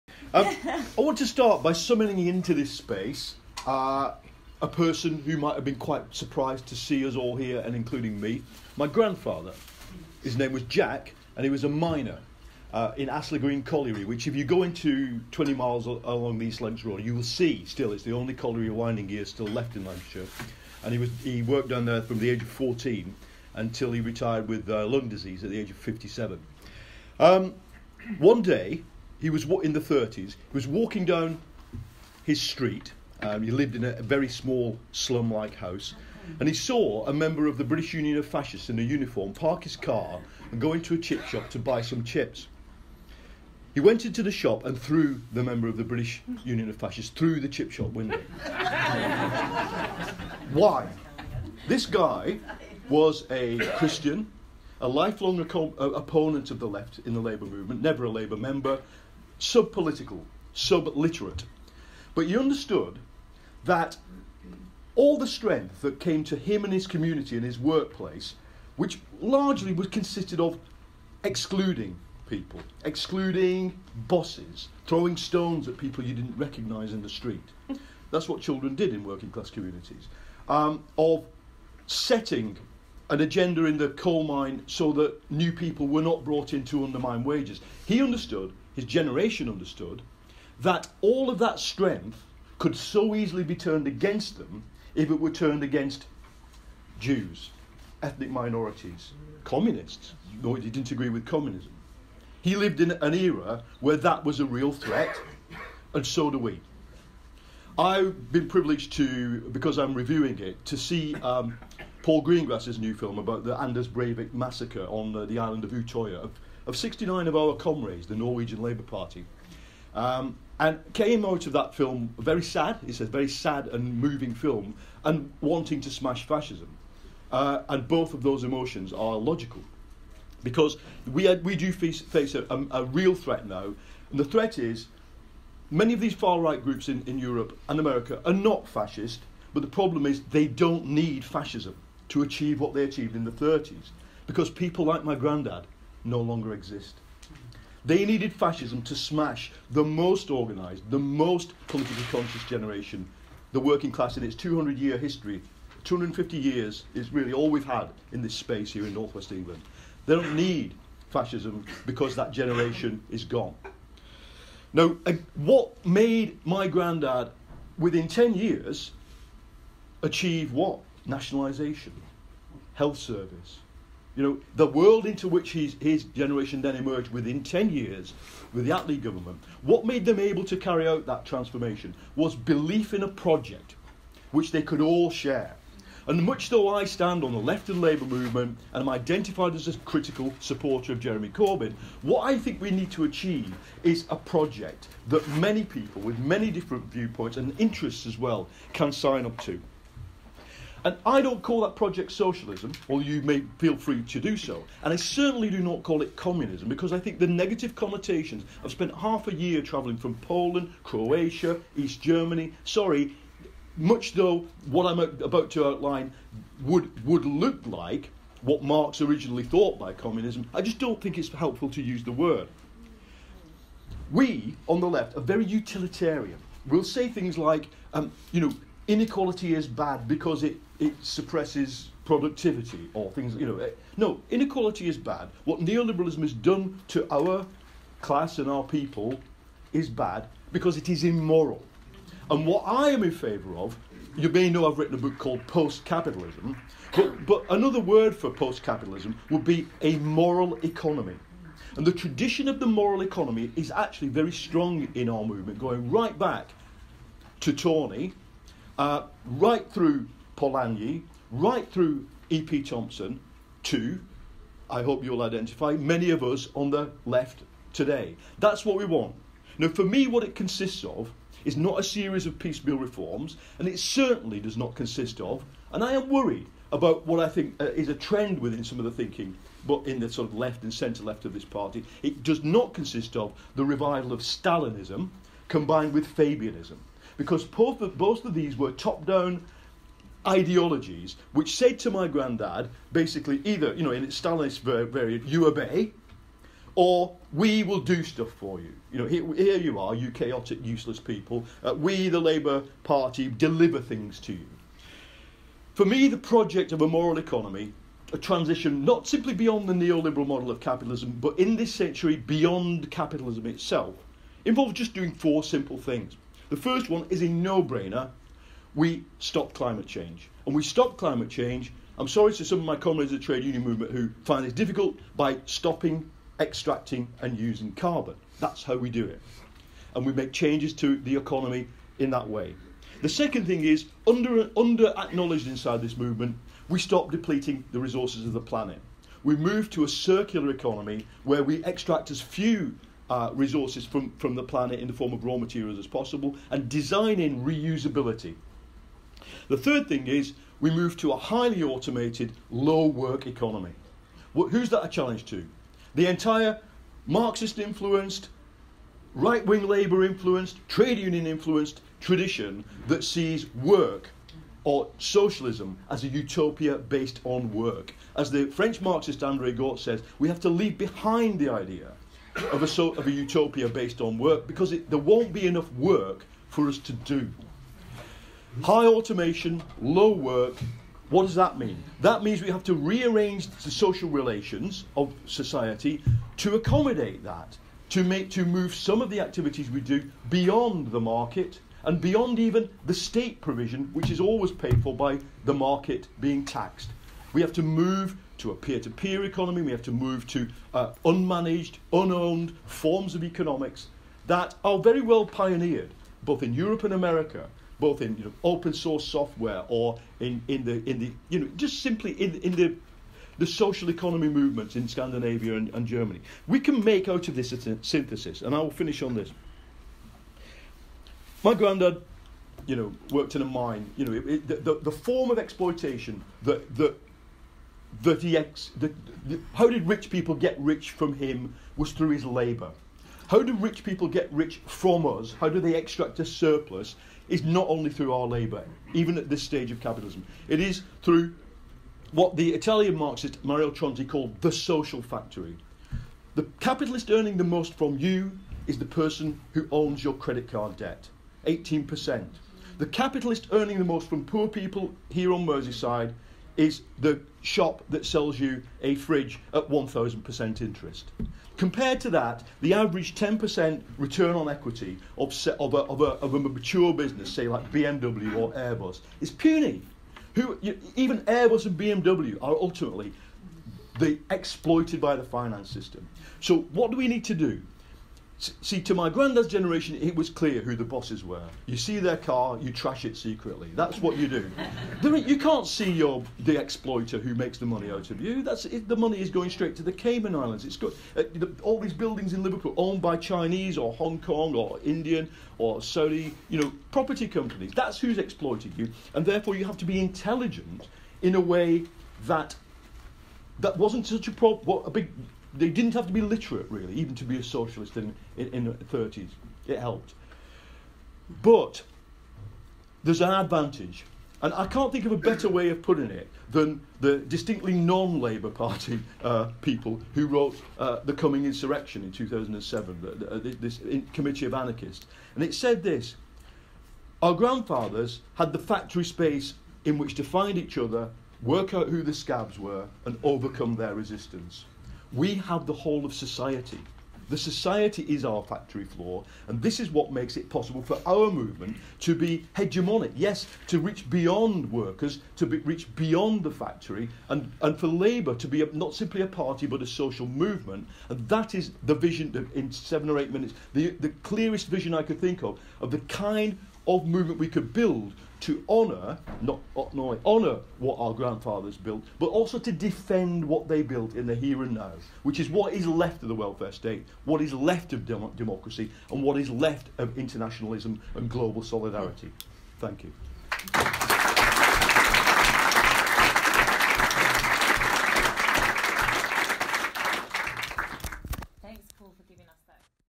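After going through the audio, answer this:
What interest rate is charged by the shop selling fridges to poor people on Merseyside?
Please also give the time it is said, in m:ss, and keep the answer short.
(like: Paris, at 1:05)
1000%, at 7:39.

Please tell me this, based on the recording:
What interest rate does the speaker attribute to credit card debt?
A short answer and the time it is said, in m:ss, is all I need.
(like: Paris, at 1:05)
18%, at 7:31.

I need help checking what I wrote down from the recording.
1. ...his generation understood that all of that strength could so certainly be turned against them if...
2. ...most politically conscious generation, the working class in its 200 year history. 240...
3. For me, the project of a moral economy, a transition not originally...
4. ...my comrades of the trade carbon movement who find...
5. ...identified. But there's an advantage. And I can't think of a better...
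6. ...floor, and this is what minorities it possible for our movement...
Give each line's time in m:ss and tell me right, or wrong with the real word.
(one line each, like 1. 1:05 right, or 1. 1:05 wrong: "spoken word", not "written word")
1. 1:28 wrong: "easily", not "certainly"
2. 2:30 wrong: "250", not "240"
3. 5:05 wrong: "simply", not "originally"
4. 5:22 wrong: "union", not "carbon"
5. 8:29 wrong: "helped", not "identified"
6. 8:58 wrong: "makes", not "minorities".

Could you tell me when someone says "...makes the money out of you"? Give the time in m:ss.
8:07.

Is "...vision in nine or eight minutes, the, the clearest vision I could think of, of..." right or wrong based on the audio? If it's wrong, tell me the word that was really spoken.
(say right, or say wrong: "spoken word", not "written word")
wrong: "seven", not "nine".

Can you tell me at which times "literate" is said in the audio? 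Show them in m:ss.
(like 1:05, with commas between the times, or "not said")
1:00, 8:26.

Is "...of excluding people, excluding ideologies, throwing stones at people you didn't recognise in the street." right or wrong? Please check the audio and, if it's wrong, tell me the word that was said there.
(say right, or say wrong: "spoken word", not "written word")
wrong: "bosses", not "ideologies".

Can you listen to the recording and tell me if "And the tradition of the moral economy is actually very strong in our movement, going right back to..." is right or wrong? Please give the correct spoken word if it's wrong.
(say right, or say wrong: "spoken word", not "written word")
right.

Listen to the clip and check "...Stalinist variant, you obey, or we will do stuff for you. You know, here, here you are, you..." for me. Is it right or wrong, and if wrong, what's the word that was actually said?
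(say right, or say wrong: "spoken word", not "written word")
right.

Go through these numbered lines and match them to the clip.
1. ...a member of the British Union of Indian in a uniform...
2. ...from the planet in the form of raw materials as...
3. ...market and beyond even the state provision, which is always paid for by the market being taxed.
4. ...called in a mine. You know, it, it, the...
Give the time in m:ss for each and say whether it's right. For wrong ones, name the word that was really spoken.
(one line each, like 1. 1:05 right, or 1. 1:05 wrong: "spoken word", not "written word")
1. 0:37 wrong: "Fascists", not "Indian"
2. 5:44 right
3. 6:31 right
4. 7:03 wrong: "worked", not "called".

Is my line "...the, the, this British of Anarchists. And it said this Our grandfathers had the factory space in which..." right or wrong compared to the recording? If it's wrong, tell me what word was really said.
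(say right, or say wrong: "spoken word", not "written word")
wrong: "Committee", not "British".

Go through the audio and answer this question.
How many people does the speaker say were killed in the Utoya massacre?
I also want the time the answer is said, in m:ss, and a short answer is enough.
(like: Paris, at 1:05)
69, at 1:56.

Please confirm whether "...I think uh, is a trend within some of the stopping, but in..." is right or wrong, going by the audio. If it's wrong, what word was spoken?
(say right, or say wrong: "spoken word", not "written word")
wrong: "thinking", not "stopping".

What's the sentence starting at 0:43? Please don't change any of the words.
He went into the shop and threw the member of the British Union of Fascists through the chip shop window.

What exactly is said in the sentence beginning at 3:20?
And I don't call that project socialism, although you may feel free to do so.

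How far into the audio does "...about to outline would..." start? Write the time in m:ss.
3:35.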